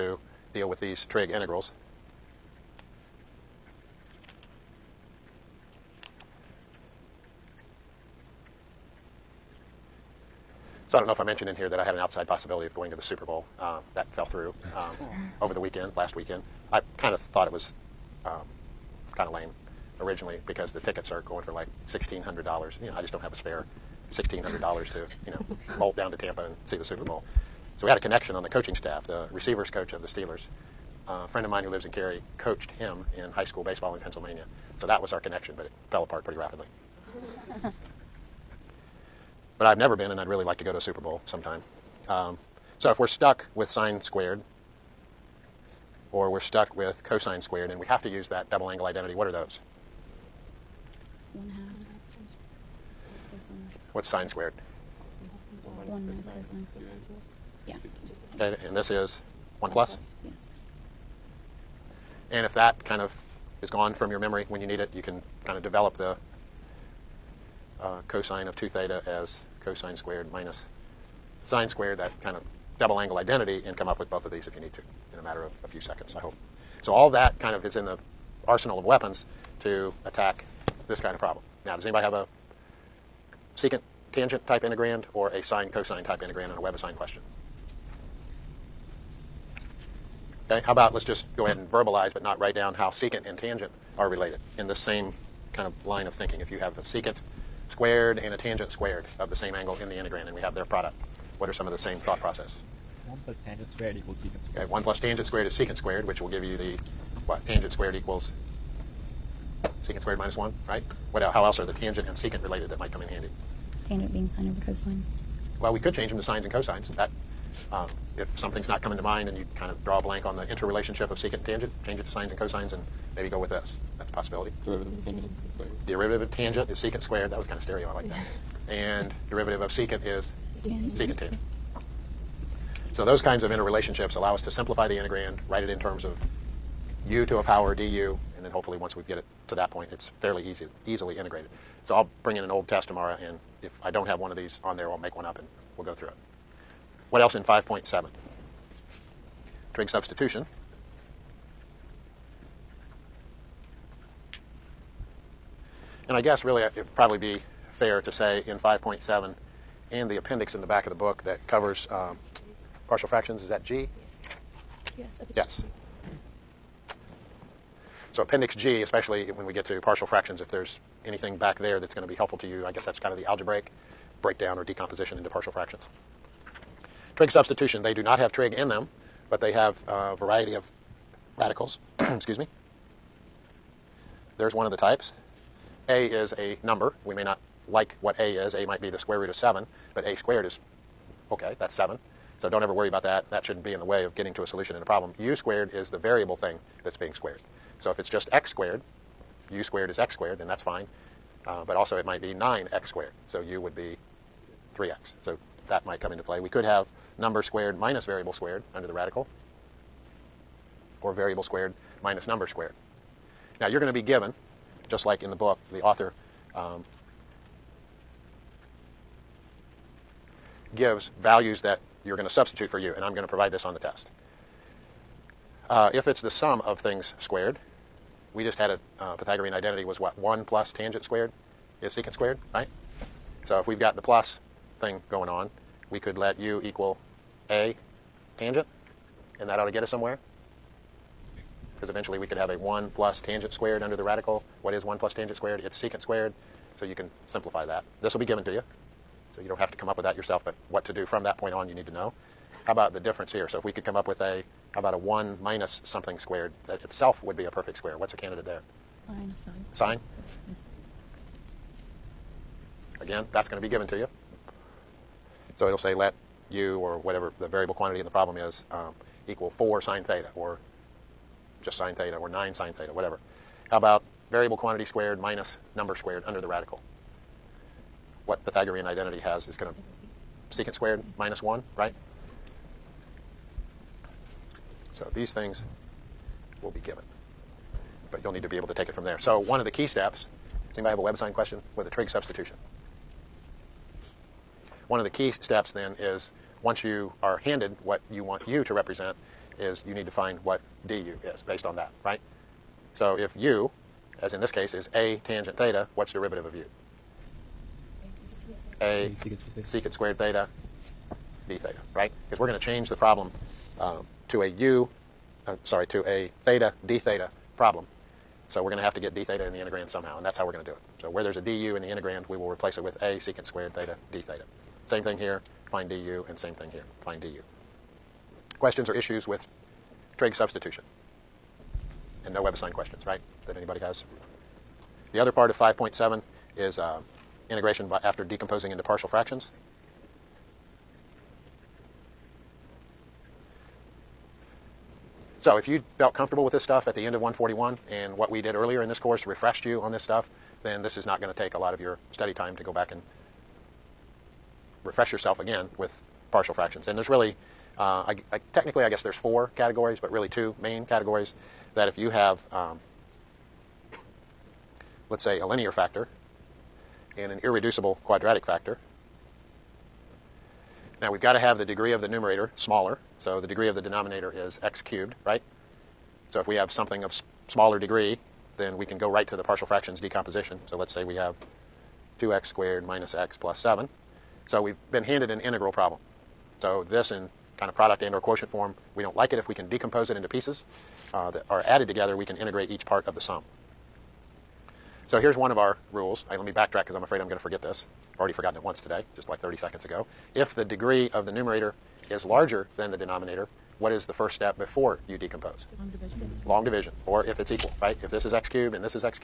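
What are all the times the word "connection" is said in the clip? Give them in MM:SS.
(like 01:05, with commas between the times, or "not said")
00:27, 00:35.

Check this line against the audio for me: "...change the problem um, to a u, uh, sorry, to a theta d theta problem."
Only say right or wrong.
right.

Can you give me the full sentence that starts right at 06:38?
I've already forgotten it once today, just like 30 seconds ago.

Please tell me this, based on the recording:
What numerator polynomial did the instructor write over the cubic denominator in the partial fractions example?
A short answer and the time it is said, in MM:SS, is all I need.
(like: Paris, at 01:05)
2x^2 - x + 7, at 06:22.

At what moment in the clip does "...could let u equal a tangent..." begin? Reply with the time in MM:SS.
03:55.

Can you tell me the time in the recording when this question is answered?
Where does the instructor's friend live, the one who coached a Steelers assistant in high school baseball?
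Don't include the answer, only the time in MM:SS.
00:31.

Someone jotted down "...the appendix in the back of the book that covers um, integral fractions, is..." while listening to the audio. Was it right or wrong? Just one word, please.
wrong.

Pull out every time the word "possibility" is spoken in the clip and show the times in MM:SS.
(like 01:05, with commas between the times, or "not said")
00:12, 02:04.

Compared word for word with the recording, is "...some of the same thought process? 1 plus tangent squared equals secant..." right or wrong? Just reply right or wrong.
right.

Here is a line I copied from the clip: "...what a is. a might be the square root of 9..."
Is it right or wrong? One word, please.
wrong.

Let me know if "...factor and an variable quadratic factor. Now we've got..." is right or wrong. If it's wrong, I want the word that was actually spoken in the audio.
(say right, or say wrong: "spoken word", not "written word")
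wrong: "irreducible", not "variable".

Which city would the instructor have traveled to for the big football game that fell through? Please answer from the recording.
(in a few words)
Tampa.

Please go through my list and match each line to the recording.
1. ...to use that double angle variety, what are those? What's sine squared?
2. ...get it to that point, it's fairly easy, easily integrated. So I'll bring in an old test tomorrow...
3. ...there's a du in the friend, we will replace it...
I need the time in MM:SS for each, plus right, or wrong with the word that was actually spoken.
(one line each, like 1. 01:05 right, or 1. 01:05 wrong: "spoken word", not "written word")
1. 00:48 wrong: "identity", not "variety"
2. 02:19 right
3. 05:21 wrong: "integrand", not "friend".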